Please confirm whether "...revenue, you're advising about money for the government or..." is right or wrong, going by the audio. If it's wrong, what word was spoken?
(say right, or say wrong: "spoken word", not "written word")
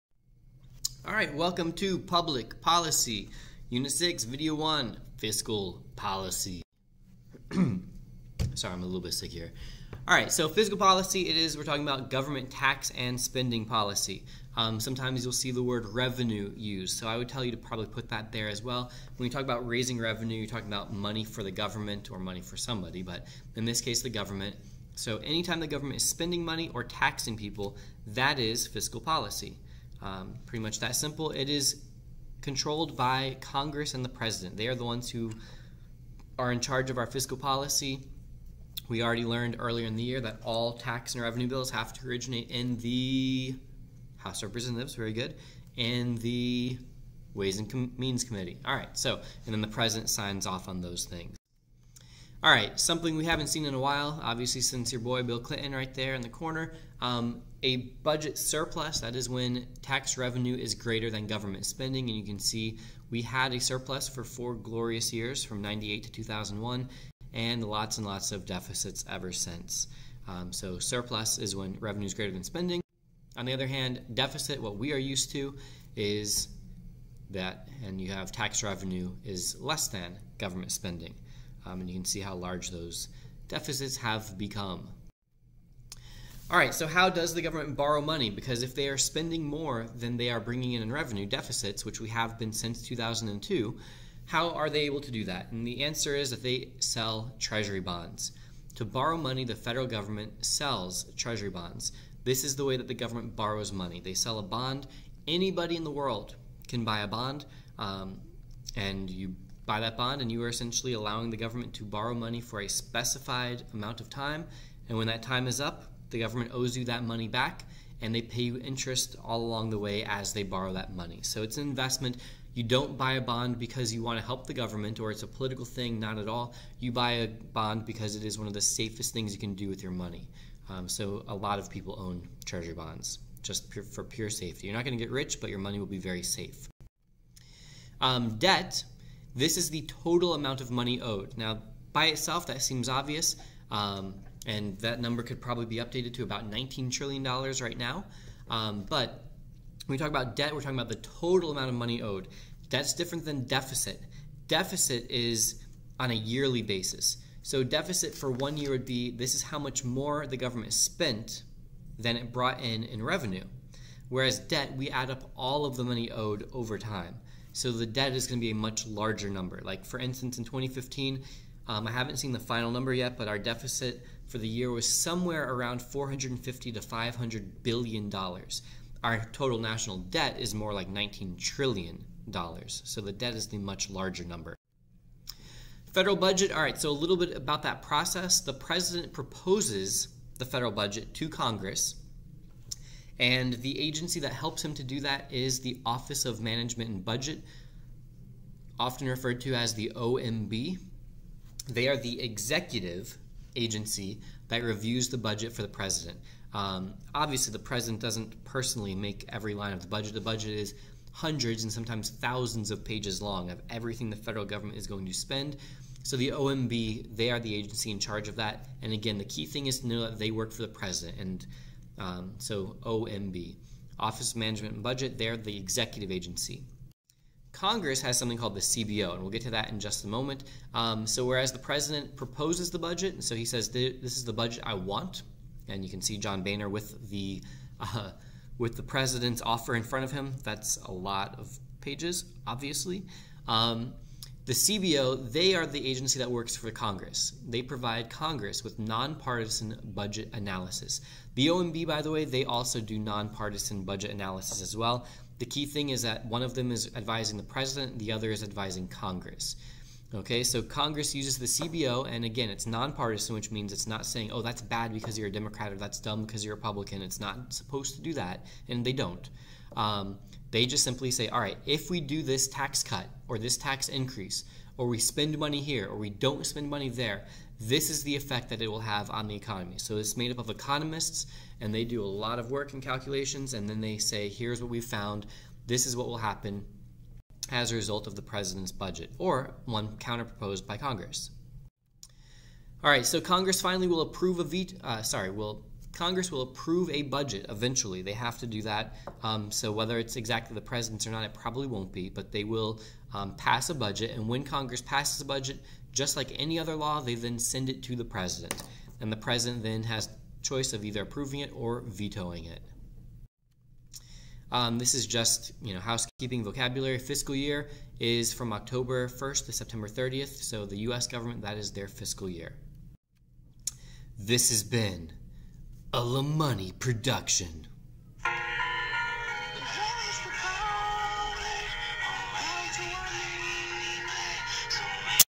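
wrong: "talking", not "advising".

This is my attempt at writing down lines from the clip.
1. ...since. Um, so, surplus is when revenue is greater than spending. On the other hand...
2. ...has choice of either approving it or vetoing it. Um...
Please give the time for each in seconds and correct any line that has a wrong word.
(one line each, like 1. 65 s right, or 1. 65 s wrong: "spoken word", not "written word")
1. 69 s right
2. 309 s right.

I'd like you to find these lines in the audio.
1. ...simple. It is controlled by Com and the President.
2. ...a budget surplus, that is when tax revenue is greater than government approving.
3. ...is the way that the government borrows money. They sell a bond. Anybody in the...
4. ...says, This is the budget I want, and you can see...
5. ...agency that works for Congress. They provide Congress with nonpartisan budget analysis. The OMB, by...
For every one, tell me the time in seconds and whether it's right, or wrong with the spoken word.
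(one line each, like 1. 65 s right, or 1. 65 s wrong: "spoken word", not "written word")
1. 30 s wrong: "Congress", not "Com"
2. 57 s wrong: "spending", not "approving"
3. 102 s right
4. 233 s right
5. 245 s right.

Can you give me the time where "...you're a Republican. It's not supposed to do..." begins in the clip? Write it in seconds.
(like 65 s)
266 s.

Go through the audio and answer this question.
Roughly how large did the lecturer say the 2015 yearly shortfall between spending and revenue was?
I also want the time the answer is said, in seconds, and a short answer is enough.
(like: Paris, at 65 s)
450 to 500 billion dollars, at 175 s.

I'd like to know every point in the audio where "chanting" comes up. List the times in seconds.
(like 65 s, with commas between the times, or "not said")
not said.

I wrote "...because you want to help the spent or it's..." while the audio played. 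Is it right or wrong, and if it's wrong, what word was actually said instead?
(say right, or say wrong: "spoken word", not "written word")
wrong: "government", not "spent".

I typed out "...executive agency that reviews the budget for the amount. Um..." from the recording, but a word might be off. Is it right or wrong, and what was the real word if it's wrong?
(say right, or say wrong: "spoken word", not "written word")
wrong: "president", not "amount".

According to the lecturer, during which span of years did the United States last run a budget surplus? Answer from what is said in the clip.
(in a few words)
1998 to 2001.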